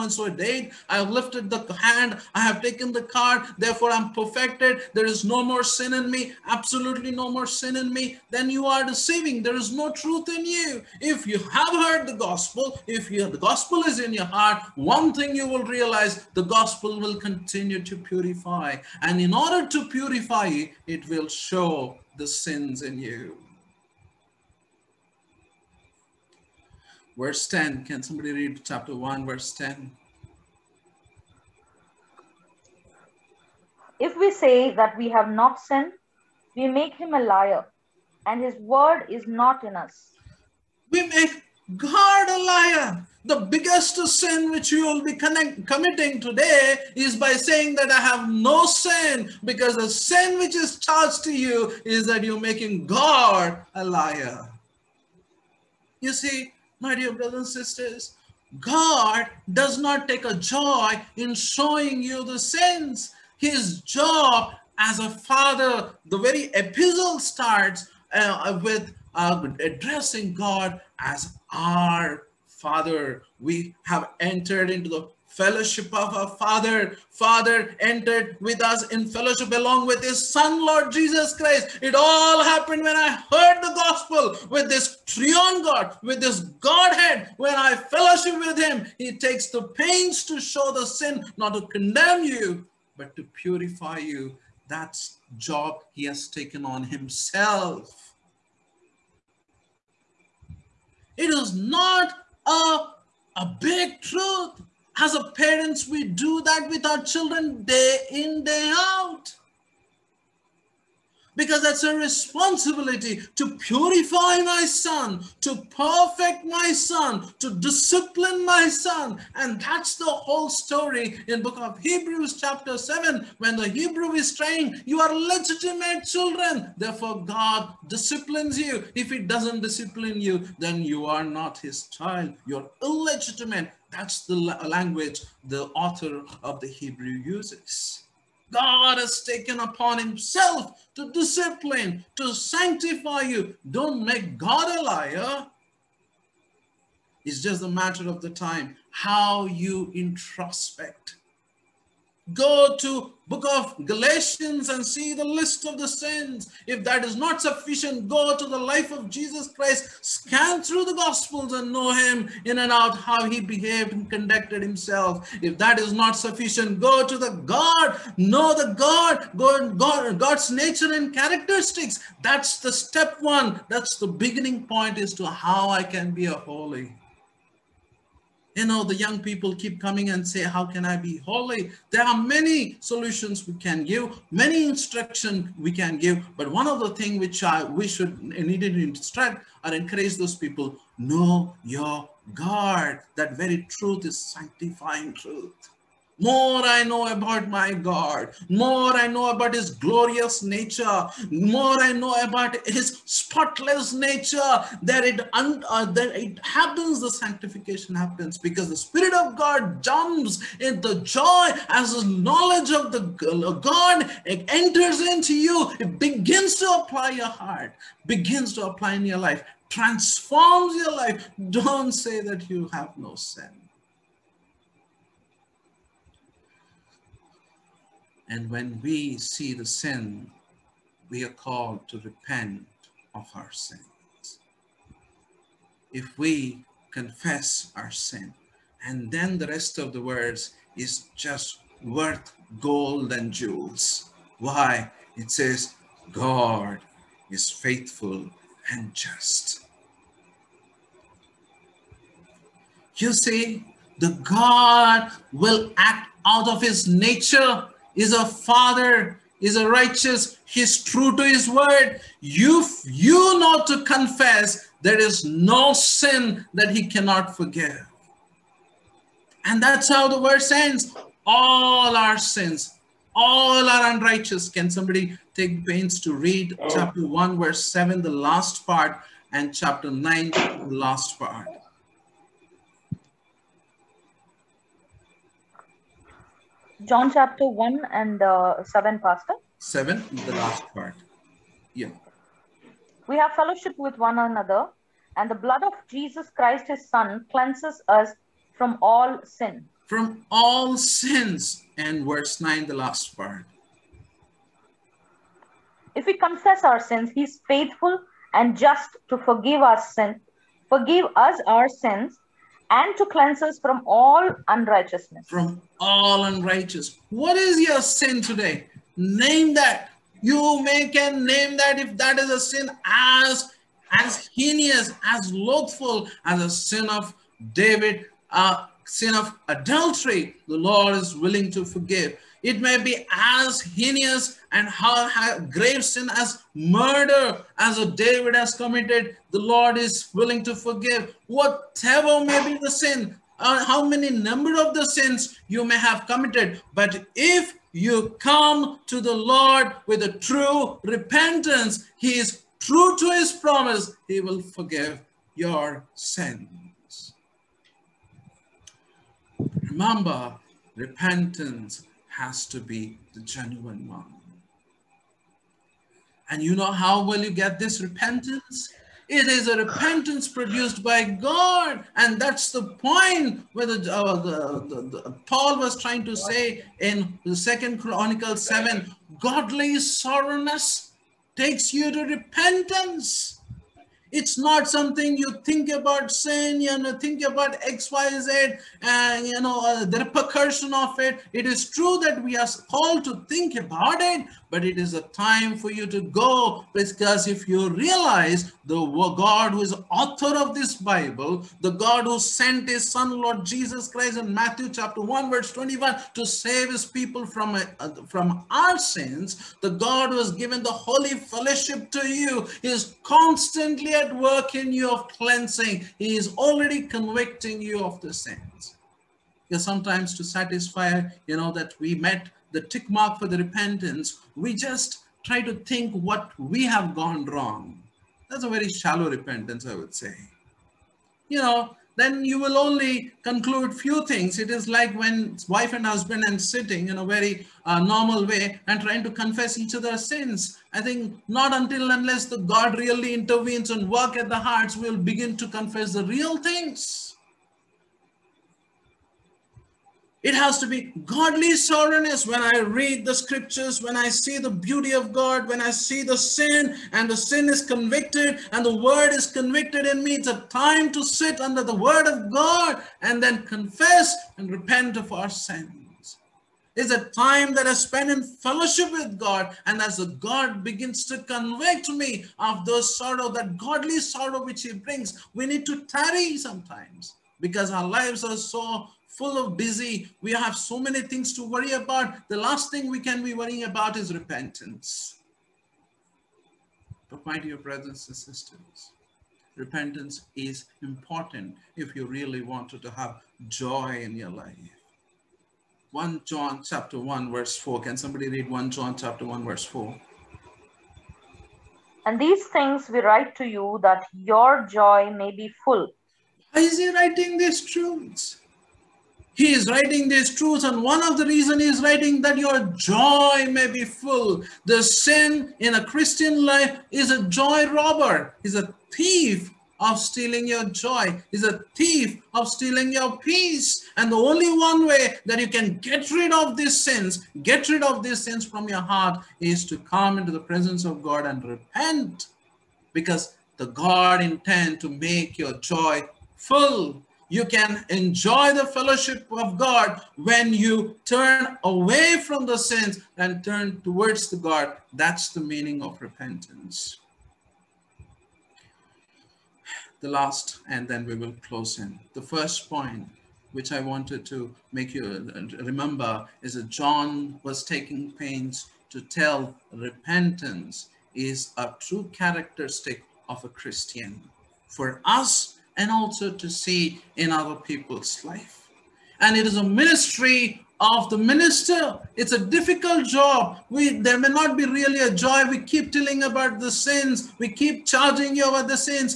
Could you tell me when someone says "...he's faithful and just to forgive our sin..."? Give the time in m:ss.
5:07.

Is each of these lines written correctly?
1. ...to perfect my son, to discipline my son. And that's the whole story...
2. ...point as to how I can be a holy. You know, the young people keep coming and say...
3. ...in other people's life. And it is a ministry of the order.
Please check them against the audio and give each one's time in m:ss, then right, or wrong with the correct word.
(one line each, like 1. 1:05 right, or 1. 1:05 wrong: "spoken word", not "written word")
1. 1:55 right
2. 2:54 right
3. 9:27 wrong: "minister", not "order".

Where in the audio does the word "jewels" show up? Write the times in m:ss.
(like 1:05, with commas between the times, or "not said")
4:03.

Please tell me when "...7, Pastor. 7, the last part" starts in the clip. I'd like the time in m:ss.
4:48.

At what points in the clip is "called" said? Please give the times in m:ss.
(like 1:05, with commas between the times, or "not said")
3:51, 6:32.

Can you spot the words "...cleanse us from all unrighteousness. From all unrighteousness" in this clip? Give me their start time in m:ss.
5:13.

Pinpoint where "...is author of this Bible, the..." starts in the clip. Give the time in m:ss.
6:39.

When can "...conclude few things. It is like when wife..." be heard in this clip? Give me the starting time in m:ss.
7:13.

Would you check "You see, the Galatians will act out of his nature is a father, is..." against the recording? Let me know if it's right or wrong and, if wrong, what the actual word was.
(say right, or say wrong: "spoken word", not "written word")
wrong: "God", not "Galatians".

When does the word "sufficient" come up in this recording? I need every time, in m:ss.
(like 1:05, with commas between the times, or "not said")
2:37, 2:46.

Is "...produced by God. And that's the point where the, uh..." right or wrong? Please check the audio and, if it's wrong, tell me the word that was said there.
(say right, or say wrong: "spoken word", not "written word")
right.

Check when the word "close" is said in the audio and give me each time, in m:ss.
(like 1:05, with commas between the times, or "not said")
9:11.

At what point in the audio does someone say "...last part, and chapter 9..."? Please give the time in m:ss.
4:38.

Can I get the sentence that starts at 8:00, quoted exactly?
We have so many things to worry about.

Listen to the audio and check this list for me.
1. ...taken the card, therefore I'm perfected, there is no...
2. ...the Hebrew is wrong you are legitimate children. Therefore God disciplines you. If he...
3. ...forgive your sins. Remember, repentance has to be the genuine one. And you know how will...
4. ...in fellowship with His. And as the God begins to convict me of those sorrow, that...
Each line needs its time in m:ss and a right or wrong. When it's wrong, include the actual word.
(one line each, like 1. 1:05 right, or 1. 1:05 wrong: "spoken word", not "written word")
1. 0:02 right
2. 2:03 wrong: "saying", not "wrong"
3. 5:54 right
4. 7:48 wrong: "God", not "His".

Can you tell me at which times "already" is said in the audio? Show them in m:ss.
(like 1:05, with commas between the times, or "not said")
6:56.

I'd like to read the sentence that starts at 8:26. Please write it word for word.
Why is he writing these truths?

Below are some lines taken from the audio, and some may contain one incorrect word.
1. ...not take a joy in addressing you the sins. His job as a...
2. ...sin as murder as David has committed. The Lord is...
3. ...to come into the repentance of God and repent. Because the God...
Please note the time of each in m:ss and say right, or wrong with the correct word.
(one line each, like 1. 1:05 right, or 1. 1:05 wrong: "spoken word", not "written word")
1. 0:59 wrong: "showing", not "addressing"
2. 5:35 right
3. 8:49 wrong: "presence", not "repentance".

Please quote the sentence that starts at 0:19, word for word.
And in order to purify, it will show the sins in you.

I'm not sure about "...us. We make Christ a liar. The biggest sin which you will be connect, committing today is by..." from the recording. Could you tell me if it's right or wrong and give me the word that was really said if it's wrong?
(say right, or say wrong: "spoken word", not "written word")
wrong: "God", not "Christ".